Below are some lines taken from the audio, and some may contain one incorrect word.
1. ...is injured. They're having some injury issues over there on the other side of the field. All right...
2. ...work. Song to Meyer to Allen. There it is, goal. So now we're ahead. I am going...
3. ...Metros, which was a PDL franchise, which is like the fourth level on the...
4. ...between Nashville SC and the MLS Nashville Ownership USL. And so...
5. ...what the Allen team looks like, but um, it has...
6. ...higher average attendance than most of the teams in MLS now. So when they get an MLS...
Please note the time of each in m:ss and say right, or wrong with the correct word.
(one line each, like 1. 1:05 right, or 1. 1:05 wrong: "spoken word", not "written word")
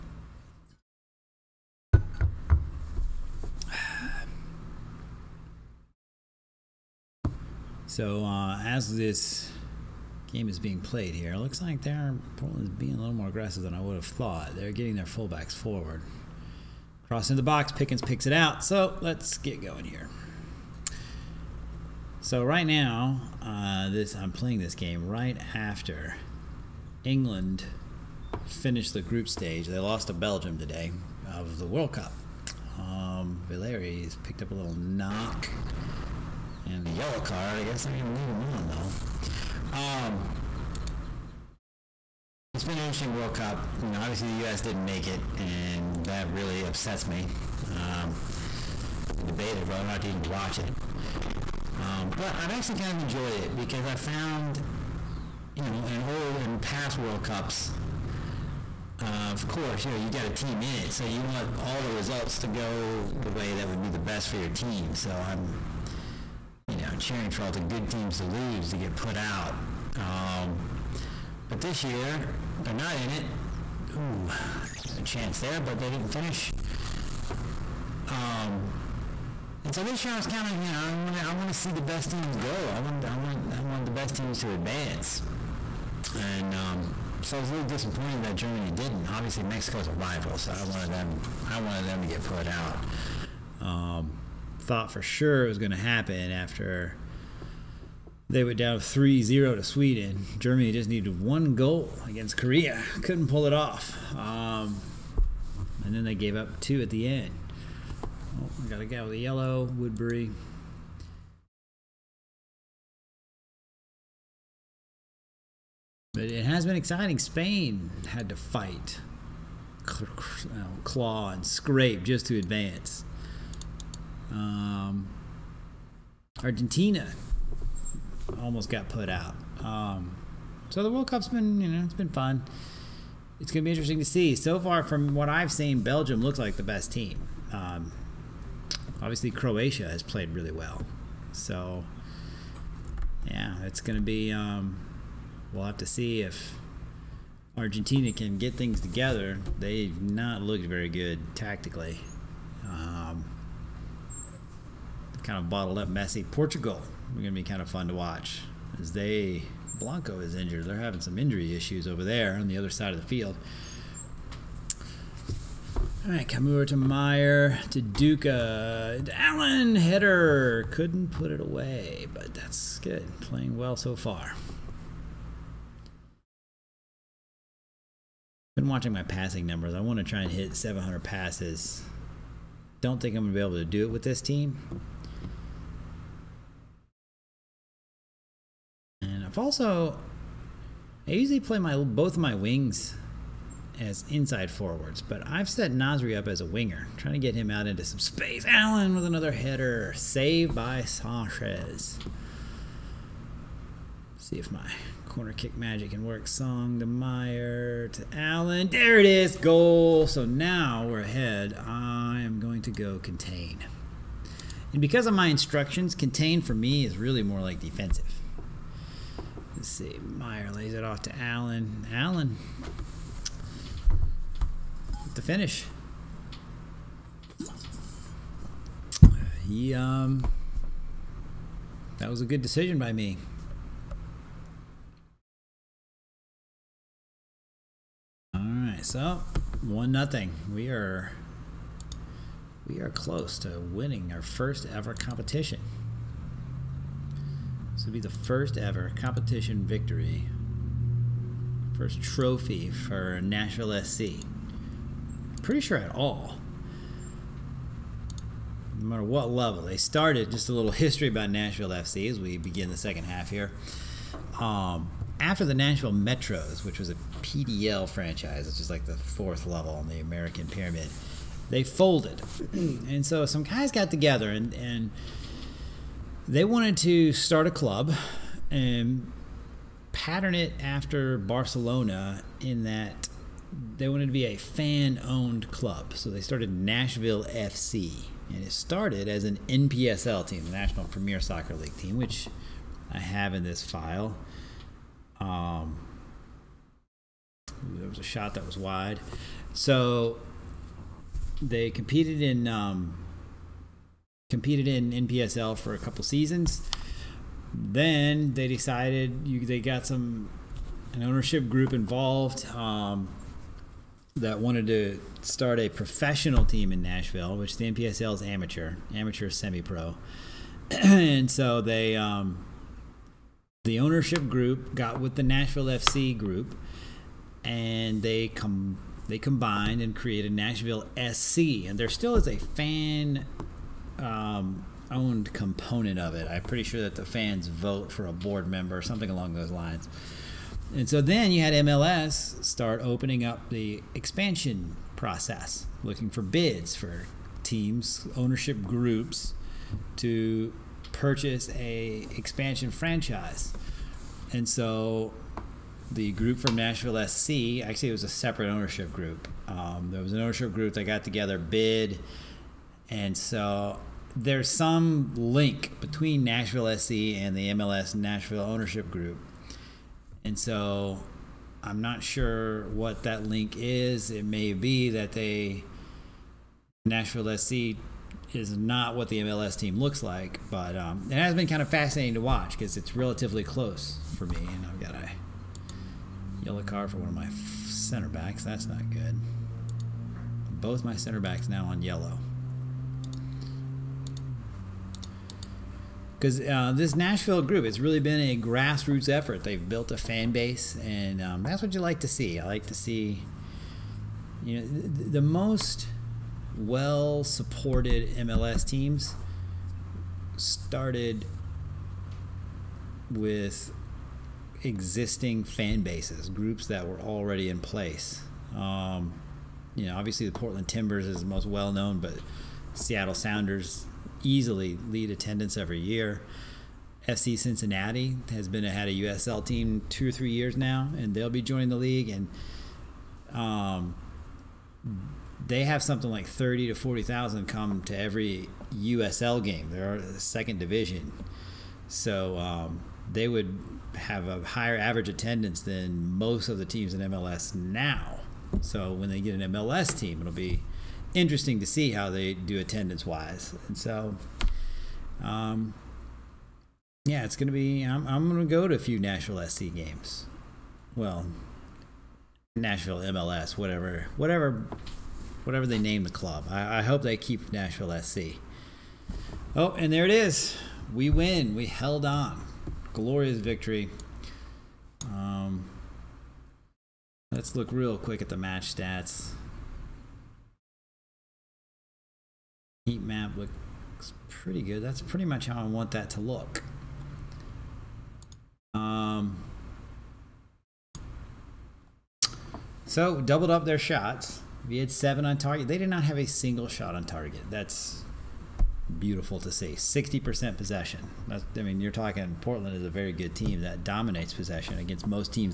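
1. 2:40 right
2. 3:26 right
3. 4:25 right
4. 6:05 wrong: "Group", not "USL"
5. 6:18 wrong: "MLS", not "Allen"
6. 7:24 right.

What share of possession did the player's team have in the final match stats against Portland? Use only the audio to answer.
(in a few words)
60%.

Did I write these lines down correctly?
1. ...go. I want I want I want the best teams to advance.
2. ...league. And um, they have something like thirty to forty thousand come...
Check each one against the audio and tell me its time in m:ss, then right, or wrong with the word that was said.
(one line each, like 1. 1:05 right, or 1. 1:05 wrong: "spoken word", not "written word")
1. 1:22 right
2. 7:11 right.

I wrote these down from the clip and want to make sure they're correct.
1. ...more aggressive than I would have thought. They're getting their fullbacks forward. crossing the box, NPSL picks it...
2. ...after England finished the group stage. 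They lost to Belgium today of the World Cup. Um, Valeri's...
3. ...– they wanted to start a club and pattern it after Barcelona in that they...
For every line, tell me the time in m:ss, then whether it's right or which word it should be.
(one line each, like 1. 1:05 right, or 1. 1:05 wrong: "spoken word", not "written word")
1. 0:13 wrong: "Pickens", not "NPSL"
2. 0:25 right
3. 4:34 right.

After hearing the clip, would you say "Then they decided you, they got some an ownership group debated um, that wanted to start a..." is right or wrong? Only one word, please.
wrong.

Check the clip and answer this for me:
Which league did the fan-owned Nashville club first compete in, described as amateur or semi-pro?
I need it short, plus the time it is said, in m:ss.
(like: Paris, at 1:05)
National Premier Soccer League, at 4:50.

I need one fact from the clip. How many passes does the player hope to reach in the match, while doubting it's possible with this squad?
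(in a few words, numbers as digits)
700.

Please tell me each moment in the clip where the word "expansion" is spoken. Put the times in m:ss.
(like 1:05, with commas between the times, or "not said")
5:43, 5:52.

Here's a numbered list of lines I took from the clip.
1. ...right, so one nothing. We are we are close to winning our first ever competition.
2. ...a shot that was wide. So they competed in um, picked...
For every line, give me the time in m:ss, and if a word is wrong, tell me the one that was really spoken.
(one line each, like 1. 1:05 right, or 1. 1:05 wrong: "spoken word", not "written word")
1. 3:58 right
2. 4:57 wrong: "competed", not "picked".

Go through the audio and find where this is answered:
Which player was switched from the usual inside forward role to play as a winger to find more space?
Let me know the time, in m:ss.
3:15.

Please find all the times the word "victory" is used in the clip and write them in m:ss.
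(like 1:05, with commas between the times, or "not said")
4:09, 7:53.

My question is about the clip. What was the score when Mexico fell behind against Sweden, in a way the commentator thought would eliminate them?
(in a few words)
3-0.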